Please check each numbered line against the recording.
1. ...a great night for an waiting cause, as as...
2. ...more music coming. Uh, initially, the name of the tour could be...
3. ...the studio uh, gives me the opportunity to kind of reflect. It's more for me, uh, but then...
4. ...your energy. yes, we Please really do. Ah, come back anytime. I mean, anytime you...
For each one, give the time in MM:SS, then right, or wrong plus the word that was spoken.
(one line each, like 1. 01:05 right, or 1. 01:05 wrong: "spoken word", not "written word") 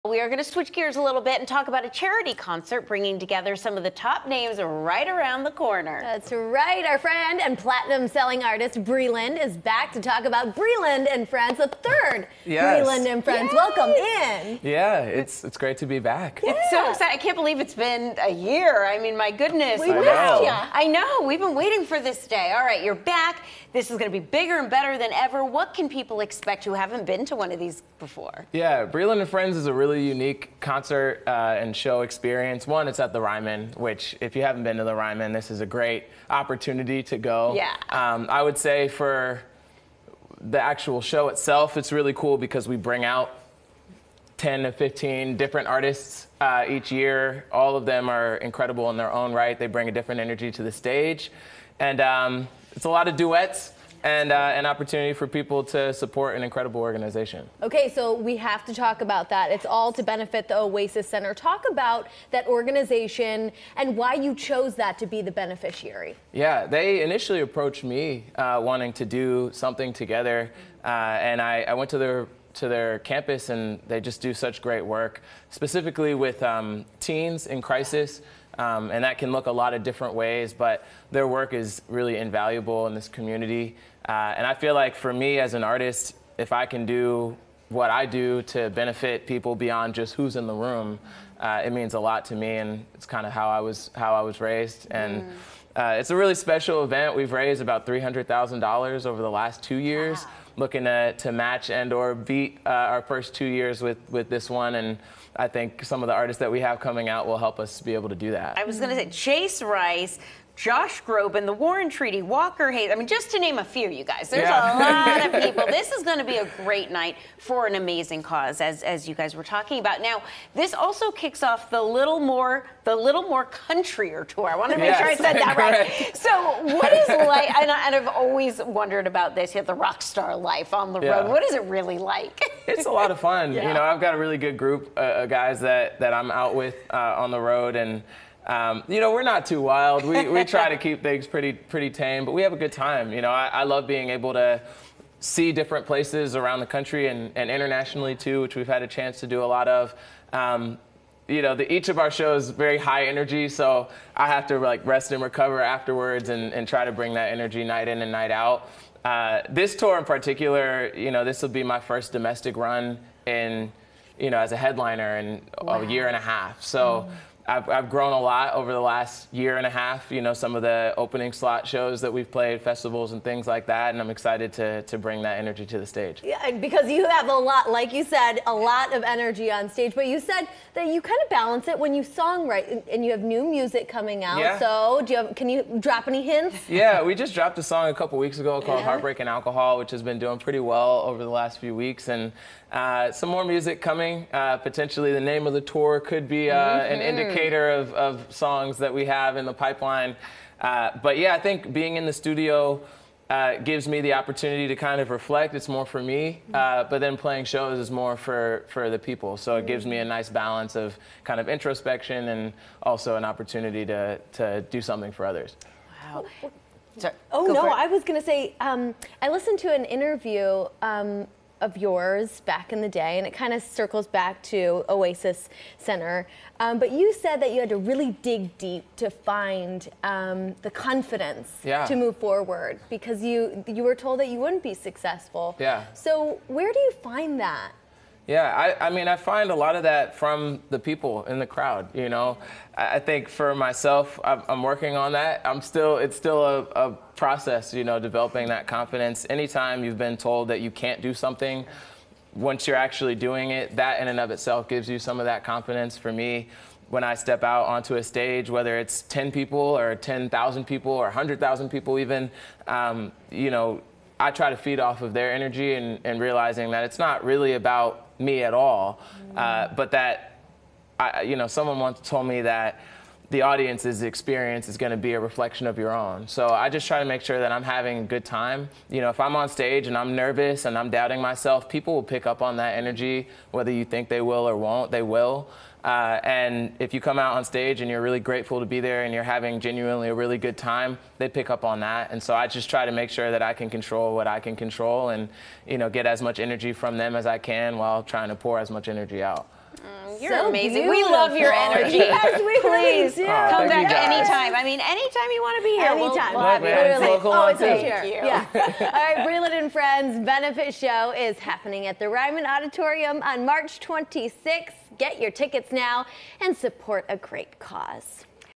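1. 01:56 wrong: "amazing", not "waiting"
2. 03:13 wrong: "potentially", not "initially"
3. 03:22 right
4. 05:01 right.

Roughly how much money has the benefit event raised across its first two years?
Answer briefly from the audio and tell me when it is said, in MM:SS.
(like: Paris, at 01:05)
$300,000, at 01:37.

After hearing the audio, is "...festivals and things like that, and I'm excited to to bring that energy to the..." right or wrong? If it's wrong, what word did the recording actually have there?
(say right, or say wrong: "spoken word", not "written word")
right.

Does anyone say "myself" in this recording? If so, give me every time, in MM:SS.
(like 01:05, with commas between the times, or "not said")
04:03, 04:41.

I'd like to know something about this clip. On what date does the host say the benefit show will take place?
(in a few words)
March 26th.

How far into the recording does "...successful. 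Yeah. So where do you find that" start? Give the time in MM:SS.
03:54.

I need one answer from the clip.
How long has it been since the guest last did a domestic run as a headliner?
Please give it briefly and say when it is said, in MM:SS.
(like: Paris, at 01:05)
a year and a half, at 02:45.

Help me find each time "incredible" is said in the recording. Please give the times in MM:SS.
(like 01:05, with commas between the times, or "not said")
00:48, 00:56.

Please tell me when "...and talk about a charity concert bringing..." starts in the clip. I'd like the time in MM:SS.
00:01.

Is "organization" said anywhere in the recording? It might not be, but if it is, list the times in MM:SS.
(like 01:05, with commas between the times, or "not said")
00:56, 01:02.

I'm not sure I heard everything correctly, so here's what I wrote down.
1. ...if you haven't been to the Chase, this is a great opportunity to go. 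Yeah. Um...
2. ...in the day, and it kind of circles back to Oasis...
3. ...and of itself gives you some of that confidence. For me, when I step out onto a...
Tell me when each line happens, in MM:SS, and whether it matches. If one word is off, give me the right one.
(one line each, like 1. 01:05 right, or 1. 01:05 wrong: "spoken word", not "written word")
1. 00:34 wrong: "Ryman", not "Chase"
2. 03:42 right
3. 04:14 right.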